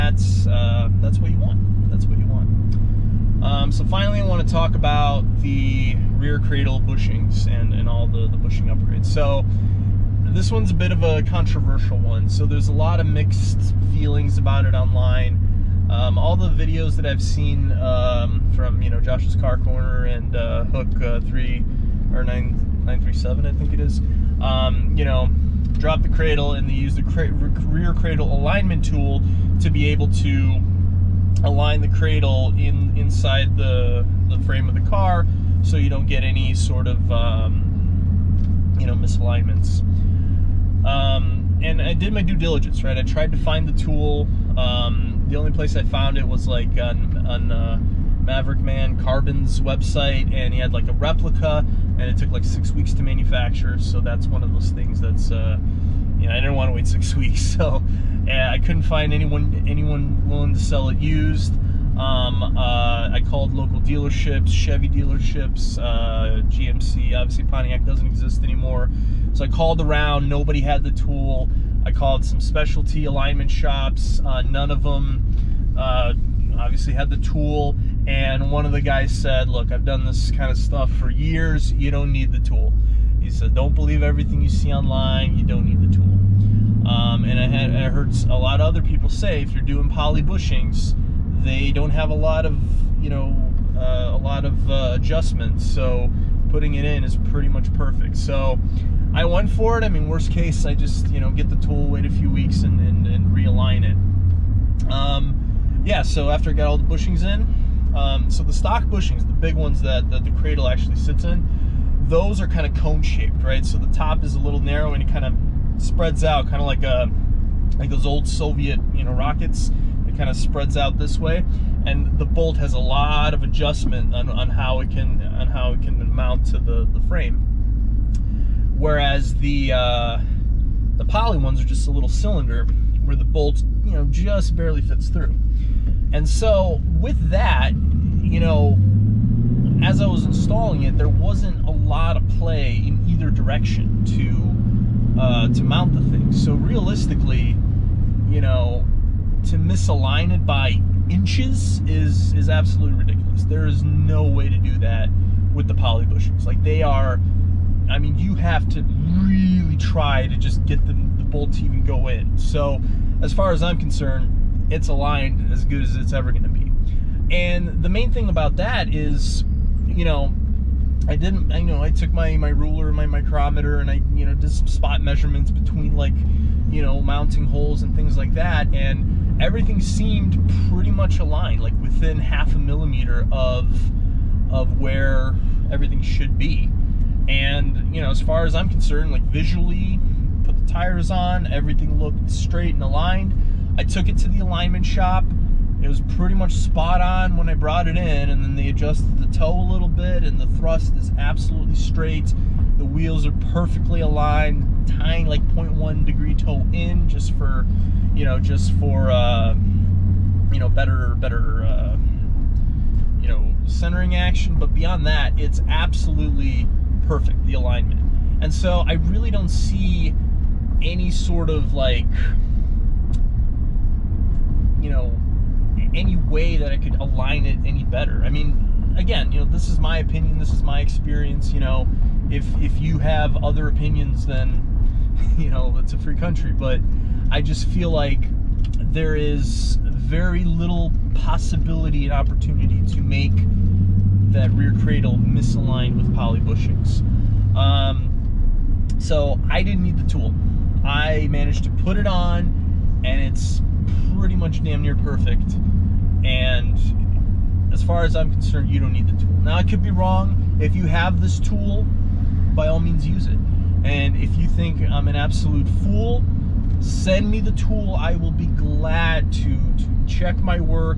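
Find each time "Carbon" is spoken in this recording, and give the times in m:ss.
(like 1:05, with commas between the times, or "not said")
0:49.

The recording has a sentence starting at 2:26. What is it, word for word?
So realistically, you know, to misalign it by inches is is absolutely ridiculous.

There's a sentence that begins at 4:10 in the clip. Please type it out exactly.
I managed to put it on and it's pretty much damn near perfect.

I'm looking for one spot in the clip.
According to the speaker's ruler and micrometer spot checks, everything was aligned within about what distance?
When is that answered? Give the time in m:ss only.
3:02.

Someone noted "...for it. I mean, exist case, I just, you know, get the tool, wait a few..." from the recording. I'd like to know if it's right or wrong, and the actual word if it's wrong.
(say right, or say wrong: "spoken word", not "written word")
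wrong: "worst", not "exist".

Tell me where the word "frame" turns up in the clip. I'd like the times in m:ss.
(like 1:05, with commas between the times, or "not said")
0:34, 2:07.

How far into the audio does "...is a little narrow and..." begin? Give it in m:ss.
1:54.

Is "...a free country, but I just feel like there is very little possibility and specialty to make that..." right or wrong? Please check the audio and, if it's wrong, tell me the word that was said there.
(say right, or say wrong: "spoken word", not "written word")
wrong: "opportunity", not "specialty".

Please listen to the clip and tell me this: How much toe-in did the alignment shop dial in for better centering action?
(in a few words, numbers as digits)
0.1 degree.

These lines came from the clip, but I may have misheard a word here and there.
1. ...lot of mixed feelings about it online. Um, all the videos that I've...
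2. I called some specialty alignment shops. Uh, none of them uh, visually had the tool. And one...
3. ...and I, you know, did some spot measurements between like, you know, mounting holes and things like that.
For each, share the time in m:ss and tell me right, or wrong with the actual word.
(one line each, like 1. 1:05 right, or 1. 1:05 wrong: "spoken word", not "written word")
1. 0:12 right
2. 1:11 wrong: "obviously", not "visually"
3. 2:53 right.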